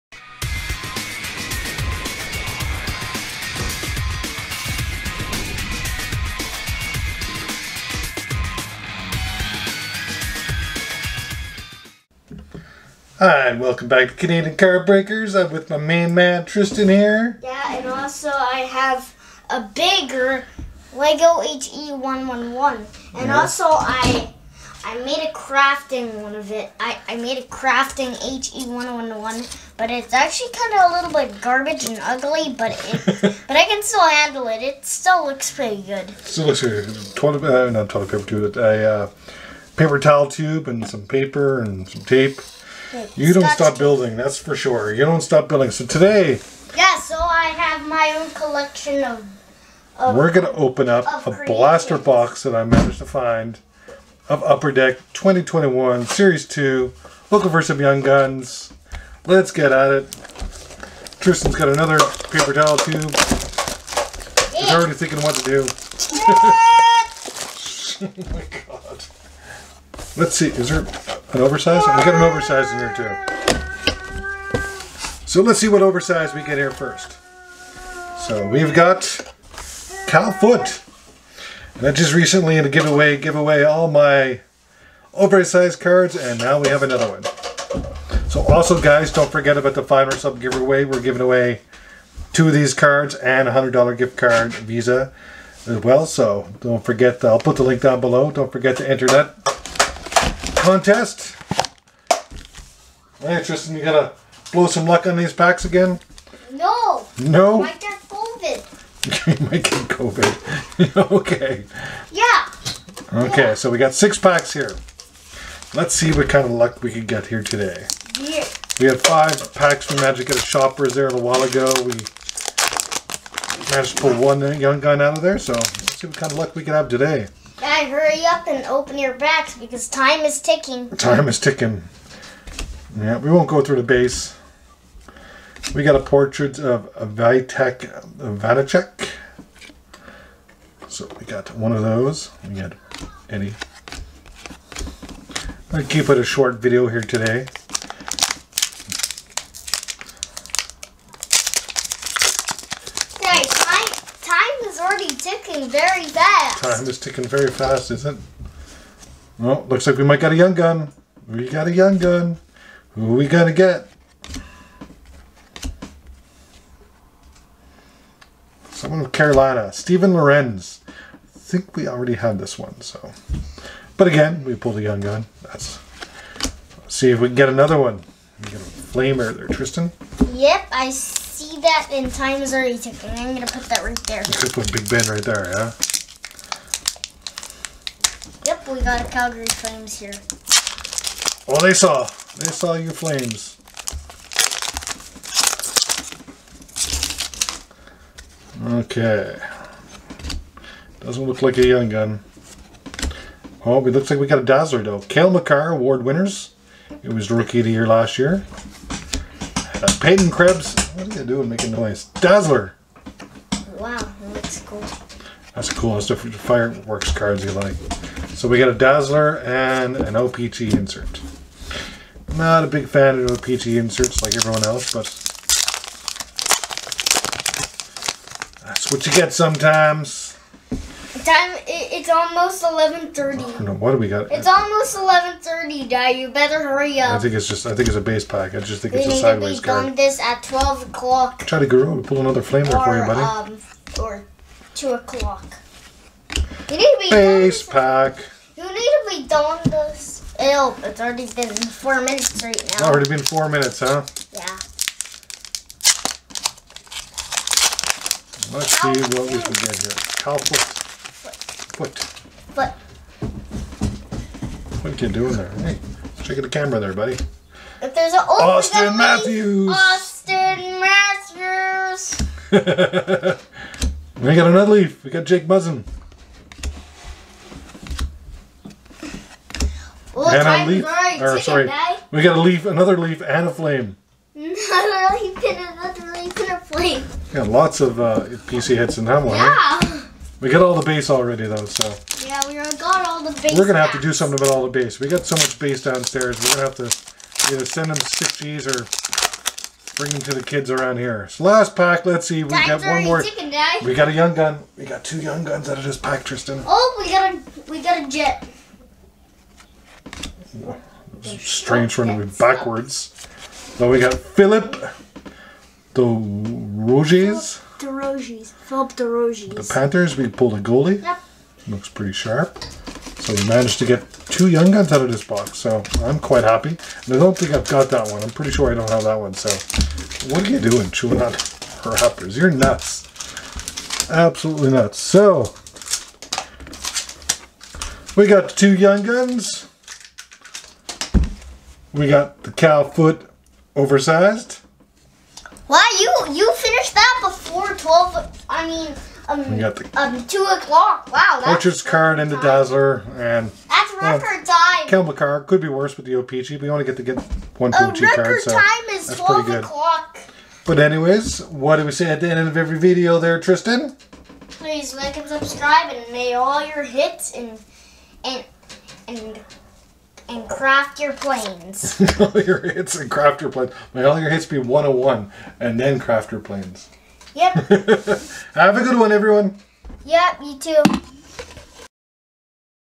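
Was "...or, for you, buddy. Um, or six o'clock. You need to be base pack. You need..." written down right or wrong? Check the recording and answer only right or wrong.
wrong.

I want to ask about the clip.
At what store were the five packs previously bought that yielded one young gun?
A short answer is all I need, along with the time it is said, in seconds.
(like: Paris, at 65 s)
Shoppers, at 120 s.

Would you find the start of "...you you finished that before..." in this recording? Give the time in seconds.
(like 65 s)
346 s.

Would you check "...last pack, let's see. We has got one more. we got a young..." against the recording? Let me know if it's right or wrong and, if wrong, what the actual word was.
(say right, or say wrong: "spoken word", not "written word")
right.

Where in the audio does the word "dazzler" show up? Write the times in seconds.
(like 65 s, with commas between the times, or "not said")
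204 s, 212 s, 218 s, 352 s.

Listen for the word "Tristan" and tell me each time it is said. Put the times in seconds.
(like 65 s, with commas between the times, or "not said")
16 s, 61 s, 103 s, 179 s, 306 s, 363 s.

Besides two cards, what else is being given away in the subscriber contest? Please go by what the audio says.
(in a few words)
$100 Visa gift card.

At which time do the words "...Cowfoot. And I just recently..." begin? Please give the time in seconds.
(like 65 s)
80 s.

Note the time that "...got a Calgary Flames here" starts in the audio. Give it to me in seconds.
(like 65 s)
188 s.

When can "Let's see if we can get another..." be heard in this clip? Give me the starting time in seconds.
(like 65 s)
176 s.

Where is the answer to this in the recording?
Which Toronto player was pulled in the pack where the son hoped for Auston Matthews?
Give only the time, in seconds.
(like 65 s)
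275 s.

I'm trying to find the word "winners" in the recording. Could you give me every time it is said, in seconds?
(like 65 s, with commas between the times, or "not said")
206 s.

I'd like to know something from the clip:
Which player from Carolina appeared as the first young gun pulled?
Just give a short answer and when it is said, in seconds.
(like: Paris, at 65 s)
Steven Lorentz, at 169 s.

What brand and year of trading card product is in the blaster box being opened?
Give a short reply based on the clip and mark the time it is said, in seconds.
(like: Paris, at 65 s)
Upper Deck 2021, at 54 s.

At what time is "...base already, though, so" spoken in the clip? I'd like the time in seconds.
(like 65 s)
290 s.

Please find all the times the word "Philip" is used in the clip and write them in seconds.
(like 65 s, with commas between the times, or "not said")
314 s, 318 s.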